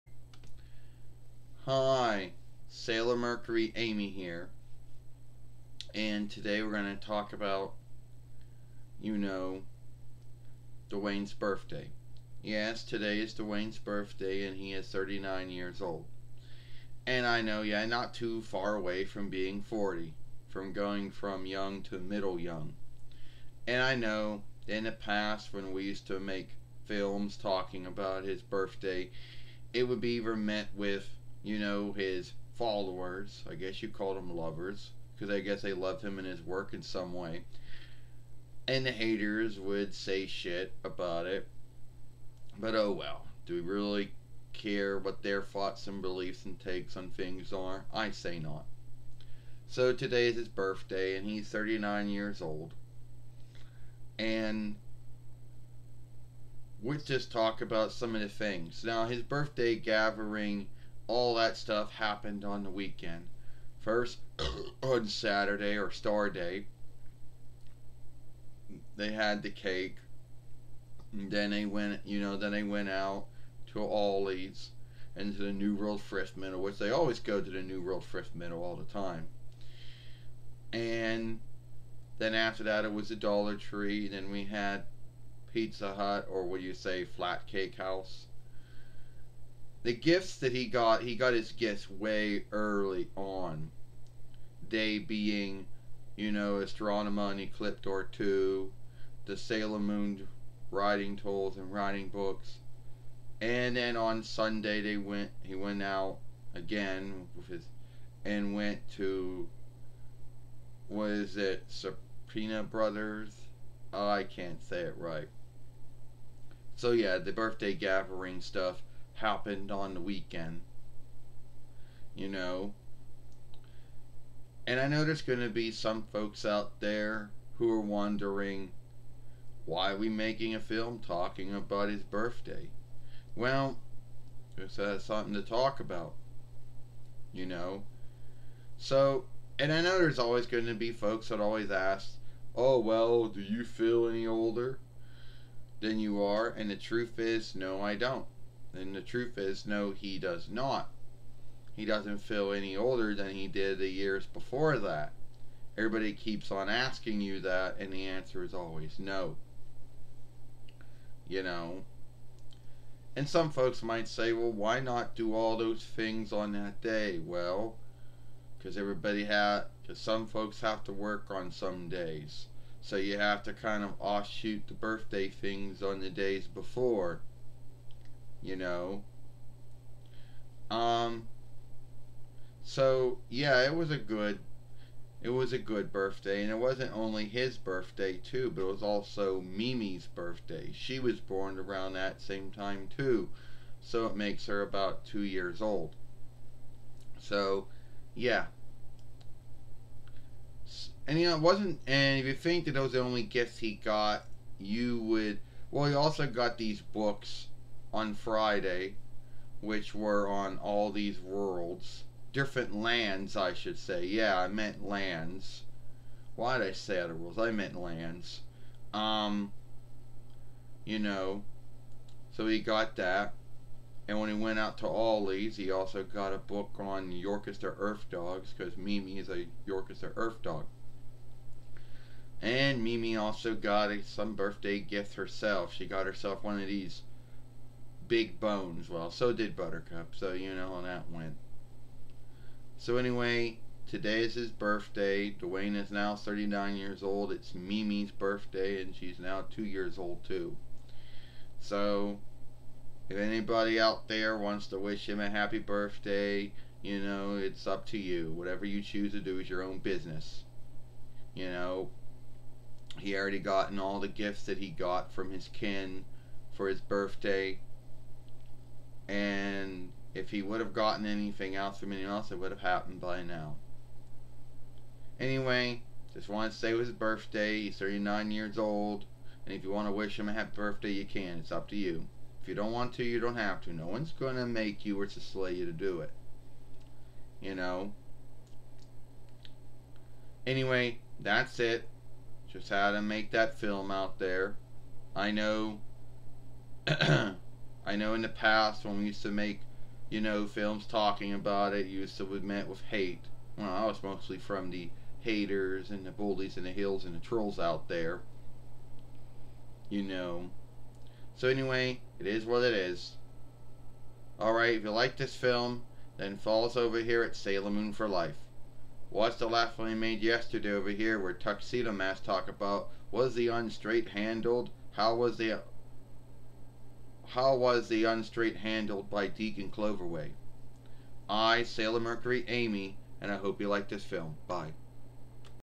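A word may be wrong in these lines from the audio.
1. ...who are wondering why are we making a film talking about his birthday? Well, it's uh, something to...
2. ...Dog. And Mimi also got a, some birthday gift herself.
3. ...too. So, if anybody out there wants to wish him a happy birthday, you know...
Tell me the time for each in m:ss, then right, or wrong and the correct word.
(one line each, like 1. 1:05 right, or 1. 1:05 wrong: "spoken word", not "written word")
1. 2:07 right
2. 3:50 right
3. 4:10 right.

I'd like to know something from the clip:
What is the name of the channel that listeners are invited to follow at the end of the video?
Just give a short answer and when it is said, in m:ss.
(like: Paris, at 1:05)
Sailor Moon for Life, at 5:17.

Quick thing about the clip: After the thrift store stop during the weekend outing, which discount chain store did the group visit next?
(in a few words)
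Dollar Tree.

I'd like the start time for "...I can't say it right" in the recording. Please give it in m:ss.
1:54.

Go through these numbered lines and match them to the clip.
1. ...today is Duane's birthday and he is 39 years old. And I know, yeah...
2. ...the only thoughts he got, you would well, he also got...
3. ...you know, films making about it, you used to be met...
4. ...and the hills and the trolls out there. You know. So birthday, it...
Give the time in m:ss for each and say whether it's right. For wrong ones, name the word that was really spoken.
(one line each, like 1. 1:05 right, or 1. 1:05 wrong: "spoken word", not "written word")
1. 0:12 right
2. 3:22 wrong: "gifts", not "thoughts"
3. 5:00 wrong: "talking", not "making"
4. 5:06 wrong: "anyway", not "birthday".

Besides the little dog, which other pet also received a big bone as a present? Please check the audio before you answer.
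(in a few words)
Buttercup.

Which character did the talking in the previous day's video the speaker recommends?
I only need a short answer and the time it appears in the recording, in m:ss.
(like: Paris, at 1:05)
Tuxedo Mask, at 5:21.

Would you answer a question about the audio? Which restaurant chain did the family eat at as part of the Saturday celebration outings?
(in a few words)
Pizza Hut.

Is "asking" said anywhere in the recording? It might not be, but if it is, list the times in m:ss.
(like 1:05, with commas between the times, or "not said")
2:36.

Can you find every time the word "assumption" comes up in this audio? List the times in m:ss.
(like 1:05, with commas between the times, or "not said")
not said.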